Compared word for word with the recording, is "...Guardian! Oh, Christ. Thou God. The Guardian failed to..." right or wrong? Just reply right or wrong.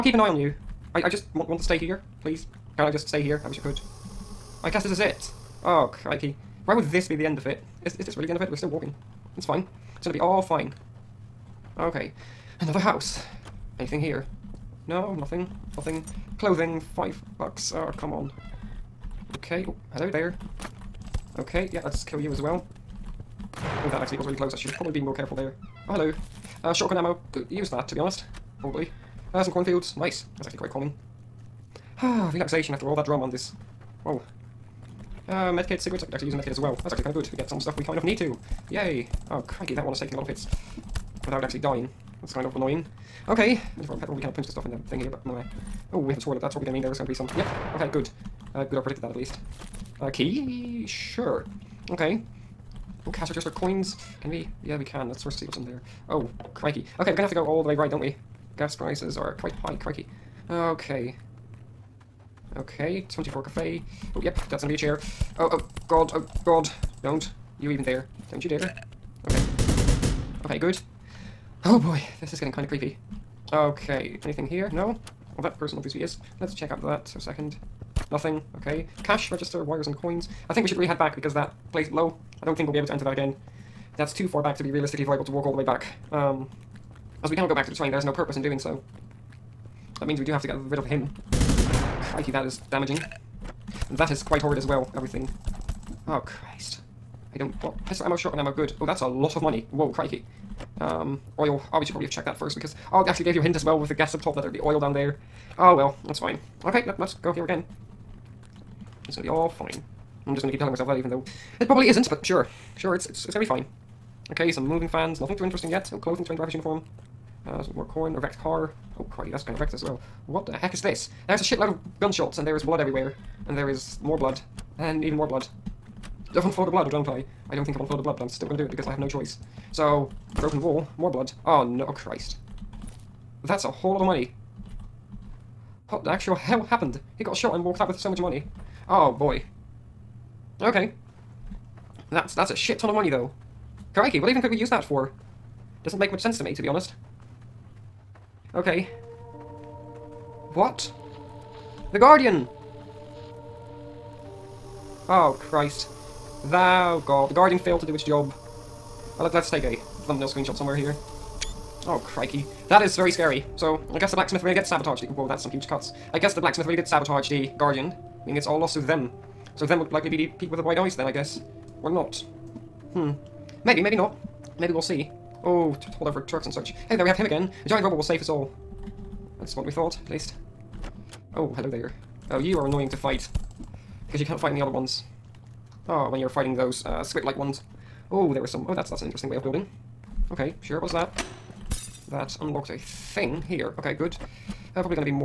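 right.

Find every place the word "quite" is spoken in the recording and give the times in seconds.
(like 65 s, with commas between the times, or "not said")
30 s, 59 s, 94 s.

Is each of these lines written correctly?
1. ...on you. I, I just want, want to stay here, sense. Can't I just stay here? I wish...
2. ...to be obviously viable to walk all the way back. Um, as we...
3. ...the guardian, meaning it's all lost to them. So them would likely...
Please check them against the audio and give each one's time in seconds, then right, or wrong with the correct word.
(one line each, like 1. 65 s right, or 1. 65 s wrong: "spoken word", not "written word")
1. 0 s wrong: "please", not "sense"
2. 84 s wrong: "realistically", not "obviously"
3. 167 s right.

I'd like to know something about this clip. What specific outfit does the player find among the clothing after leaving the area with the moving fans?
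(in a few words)
train driver's uniform.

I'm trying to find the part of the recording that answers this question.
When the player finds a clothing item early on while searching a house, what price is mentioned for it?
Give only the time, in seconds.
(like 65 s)
16 s.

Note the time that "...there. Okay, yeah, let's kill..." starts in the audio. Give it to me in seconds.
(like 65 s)
20 s.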